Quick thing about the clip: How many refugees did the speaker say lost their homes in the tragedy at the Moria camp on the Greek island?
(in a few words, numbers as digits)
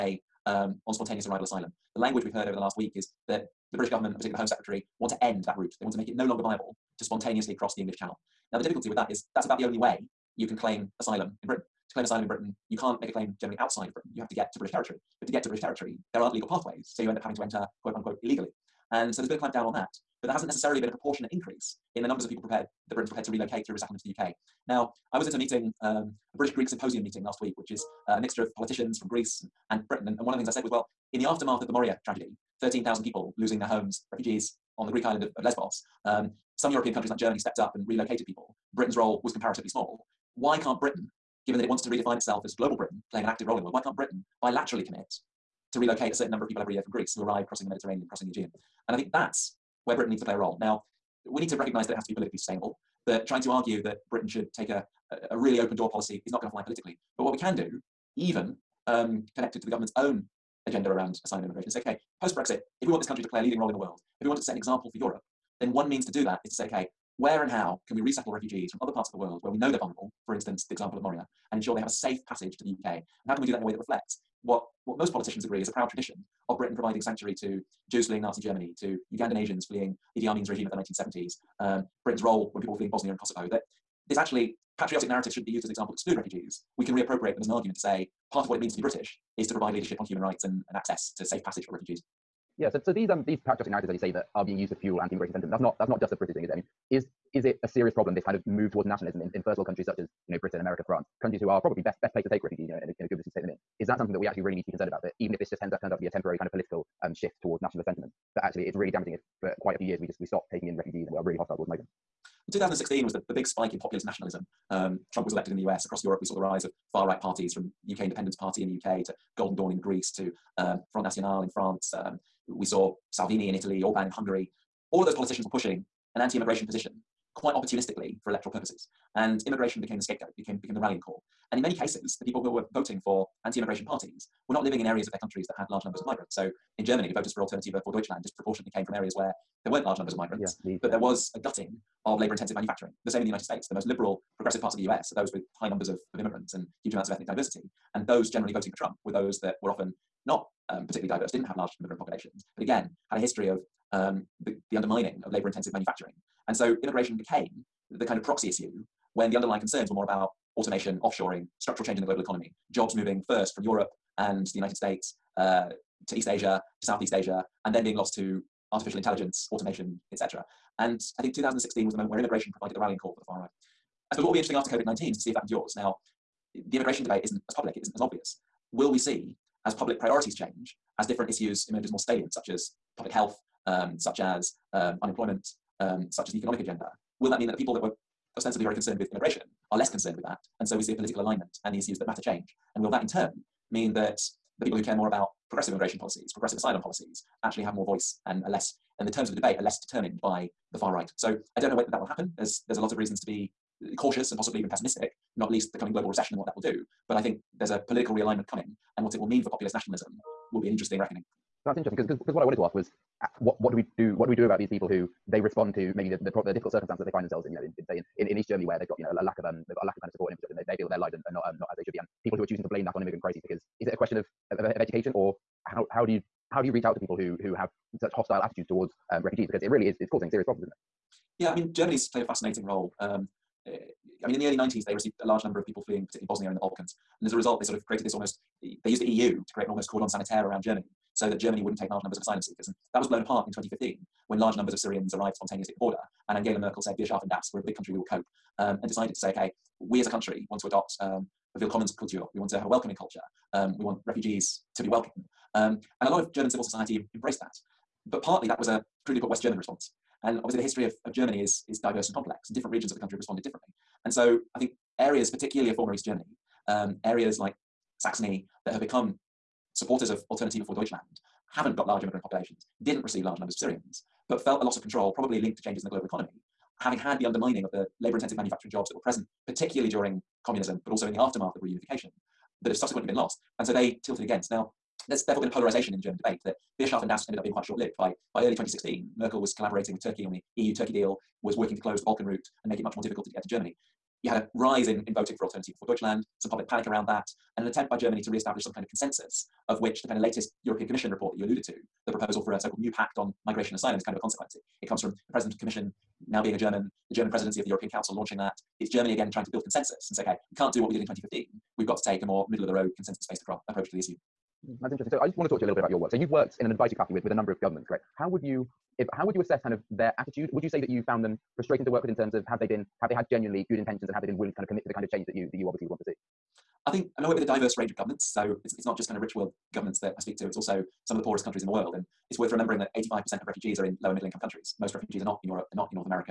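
13,000.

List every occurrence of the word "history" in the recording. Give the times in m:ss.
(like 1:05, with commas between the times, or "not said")
2:33, 4:20.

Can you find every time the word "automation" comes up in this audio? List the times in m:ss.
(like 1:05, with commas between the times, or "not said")
2:40, 2:49.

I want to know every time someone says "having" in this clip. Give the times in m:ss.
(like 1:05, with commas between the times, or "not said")
0:17, 4:36.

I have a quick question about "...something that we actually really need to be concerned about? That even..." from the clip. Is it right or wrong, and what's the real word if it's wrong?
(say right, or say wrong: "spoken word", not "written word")
right.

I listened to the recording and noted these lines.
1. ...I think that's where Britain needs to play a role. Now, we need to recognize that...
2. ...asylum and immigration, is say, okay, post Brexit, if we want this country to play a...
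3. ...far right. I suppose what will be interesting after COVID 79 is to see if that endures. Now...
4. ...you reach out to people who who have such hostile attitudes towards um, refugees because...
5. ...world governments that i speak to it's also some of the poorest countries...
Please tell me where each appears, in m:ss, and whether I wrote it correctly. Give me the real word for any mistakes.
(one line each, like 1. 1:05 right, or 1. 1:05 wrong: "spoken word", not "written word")
1. 0:48 right
2. 1:01 right
3. 2:53 wrong: "19", not "79"
4. 3:46 right
5. 5:29 right.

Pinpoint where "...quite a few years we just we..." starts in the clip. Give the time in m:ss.
1:49.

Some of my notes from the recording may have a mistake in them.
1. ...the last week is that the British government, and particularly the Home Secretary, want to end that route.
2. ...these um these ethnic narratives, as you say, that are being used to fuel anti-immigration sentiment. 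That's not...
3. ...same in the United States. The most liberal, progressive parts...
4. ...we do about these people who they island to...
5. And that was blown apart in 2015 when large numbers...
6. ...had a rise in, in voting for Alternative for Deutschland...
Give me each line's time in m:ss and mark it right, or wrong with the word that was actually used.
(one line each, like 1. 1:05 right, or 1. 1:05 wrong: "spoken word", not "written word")
1. 0:02 right
2. 1:32 wrong: "patriotic", not "ethnic"
3. 2:23 right
4. 3:34 wrong: "respond", not "island"
5. 4:02 right
6. 4:54 right.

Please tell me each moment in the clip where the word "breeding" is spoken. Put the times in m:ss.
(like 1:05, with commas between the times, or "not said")
not said.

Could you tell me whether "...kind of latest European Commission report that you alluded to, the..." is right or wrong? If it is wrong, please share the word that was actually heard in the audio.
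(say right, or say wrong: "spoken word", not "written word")
right.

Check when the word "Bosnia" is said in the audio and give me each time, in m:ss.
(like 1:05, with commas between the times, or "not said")
1:22, 3:56.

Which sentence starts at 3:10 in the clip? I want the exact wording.
And so we see a political alignment and the issues that matter change.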